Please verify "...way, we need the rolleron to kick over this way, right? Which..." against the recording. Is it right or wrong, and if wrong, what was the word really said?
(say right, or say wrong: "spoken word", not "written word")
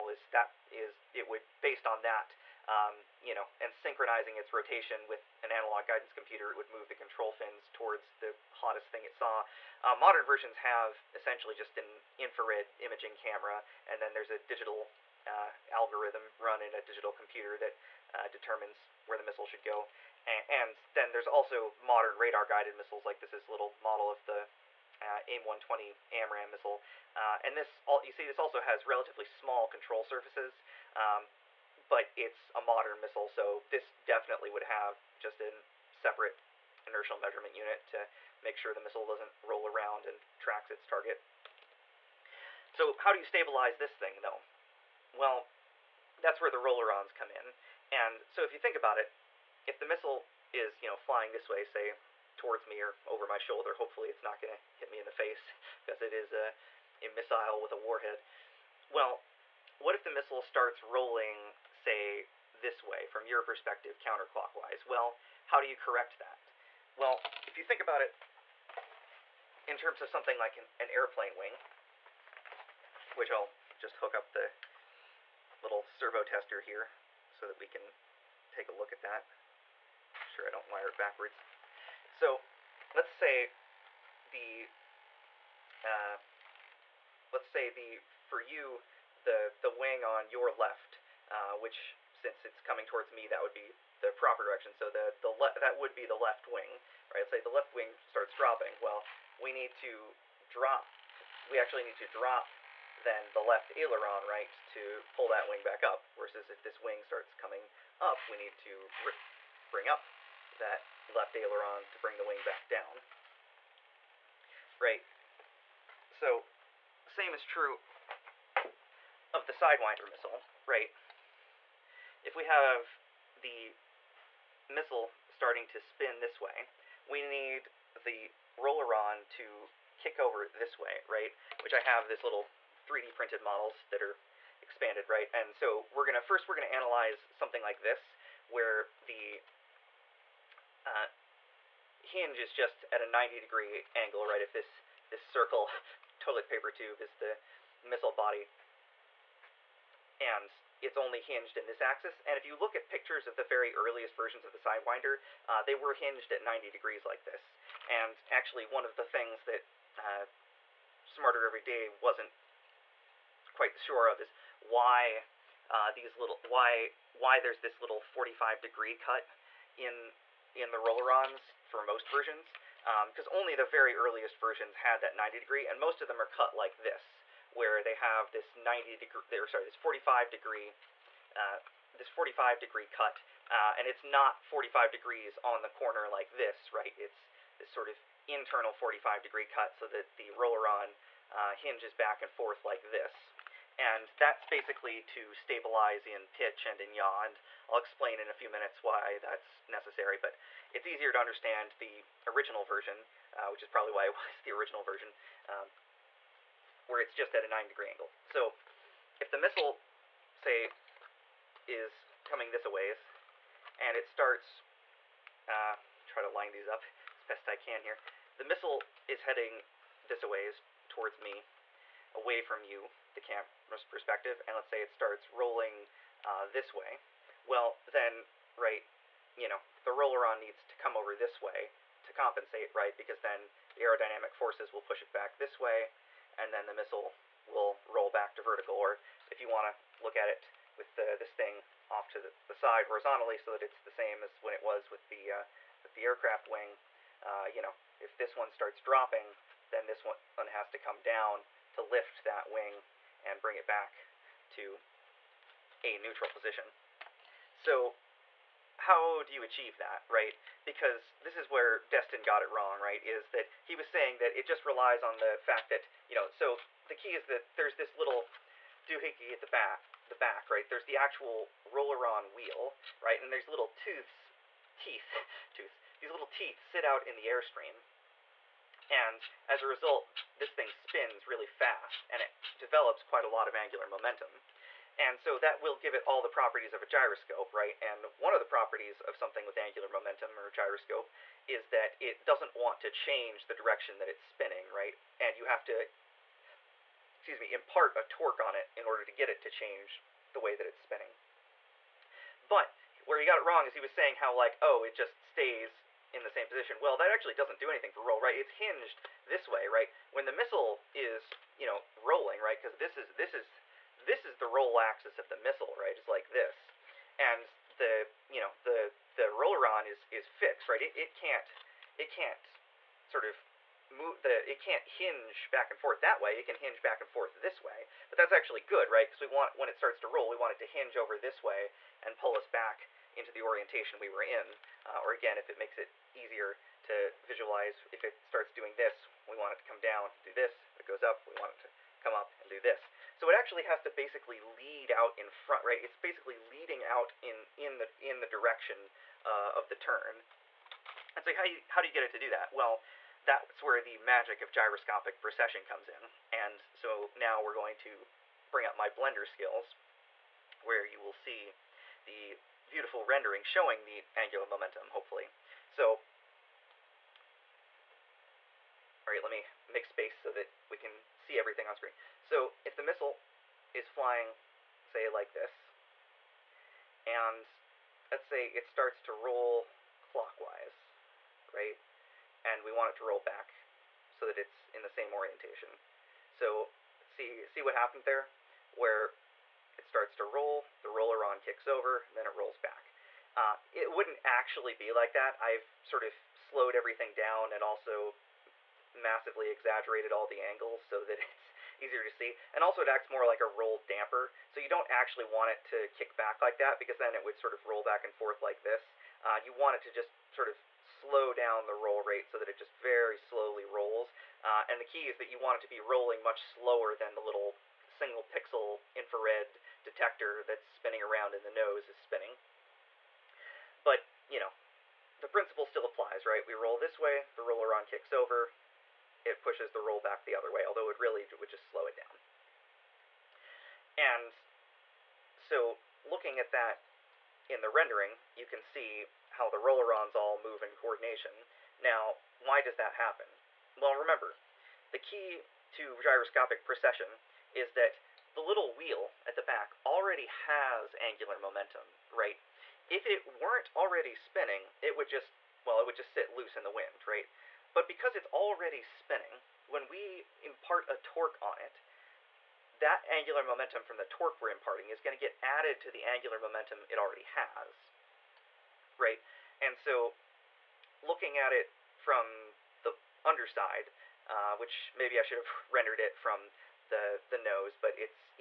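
right.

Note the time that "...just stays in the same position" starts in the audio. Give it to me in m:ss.
5:04.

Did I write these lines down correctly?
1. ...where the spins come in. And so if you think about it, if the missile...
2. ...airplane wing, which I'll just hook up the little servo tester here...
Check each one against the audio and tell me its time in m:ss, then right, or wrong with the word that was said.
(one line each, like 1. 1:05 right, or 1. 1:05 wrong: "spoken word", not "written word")
1. 0:46 wrong: "rollerons", not "spins"
2. 1:10 right.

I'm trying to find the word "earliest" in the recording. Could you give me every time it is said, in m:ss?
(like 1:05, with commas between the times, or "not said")
2:33, 2:53.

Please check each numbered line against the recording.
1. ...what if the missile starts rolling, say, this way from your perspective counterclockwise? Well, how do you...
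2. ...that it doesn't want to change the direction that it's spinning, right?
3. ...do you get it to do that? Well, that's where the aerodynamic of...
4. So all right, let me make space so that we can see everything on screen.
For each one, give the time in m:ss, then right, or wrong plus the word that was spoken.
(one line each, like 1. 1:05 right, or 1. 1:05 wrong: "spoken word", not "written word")
1. 0:59 right
2. 4:51 right
3. 5:51 wrong: "magic", not "aerodynamic"
4. 6:05 right.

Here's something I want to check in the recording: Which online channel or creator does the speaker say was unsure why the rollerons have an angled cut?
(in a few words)
Smarter Every Day.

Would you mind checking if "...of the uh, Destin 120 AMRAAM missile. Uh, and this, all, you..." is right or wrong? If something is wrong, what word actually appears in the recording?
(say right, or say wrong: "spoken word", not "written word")
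wrong: "AIM", not "Destin".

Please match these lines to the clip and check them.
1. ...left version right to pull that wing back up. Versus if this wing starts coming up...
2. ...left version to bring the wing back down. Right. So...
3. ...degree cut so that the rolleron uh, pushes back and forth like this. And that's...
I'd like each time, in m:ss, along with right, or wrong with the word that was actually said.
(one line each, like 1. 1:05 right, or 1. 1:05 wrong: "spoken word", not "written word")
1. 1:43 wrong: "aileron", not "version"
2. 1:51 wrong: "aileron", not "version"
3. 3:09 wrong: "hinges", not "pushes".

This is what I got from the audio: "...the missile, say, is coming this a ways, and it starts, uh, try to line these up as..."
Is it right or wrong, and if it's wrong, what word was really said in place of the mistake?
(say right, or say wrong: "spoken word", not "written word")
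right.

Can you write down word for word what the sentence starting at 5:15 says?
It's like this, and the you know the the roller is is fixed, right?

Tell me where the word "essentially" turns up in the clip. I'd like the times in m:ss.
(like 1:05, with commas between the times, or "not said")
0:11.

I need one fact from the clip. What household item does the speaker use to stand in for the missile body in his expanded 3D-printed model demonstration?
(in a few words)
toilet paper tube.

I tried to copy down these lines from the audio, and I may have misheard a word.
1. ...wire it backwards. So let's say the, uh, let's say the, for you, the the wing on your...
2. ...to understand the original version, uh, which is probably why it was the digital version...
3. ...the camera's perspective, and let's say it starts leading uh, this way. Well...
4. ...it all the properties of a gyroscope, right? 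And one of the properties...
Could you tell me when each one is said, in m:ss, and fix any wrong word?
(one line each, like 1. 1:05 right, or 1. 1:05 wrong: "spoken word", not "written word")
1. 1:20 right
2. 3:21 wrong: "original", not "digital"
3. 3:43 wrong: "rolling", not "leading"
4. 4:45 right.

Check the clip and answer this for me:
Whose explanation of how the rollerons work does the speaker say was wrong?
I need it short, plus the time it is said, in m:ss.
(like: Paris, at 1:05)
Destin, at 4:21.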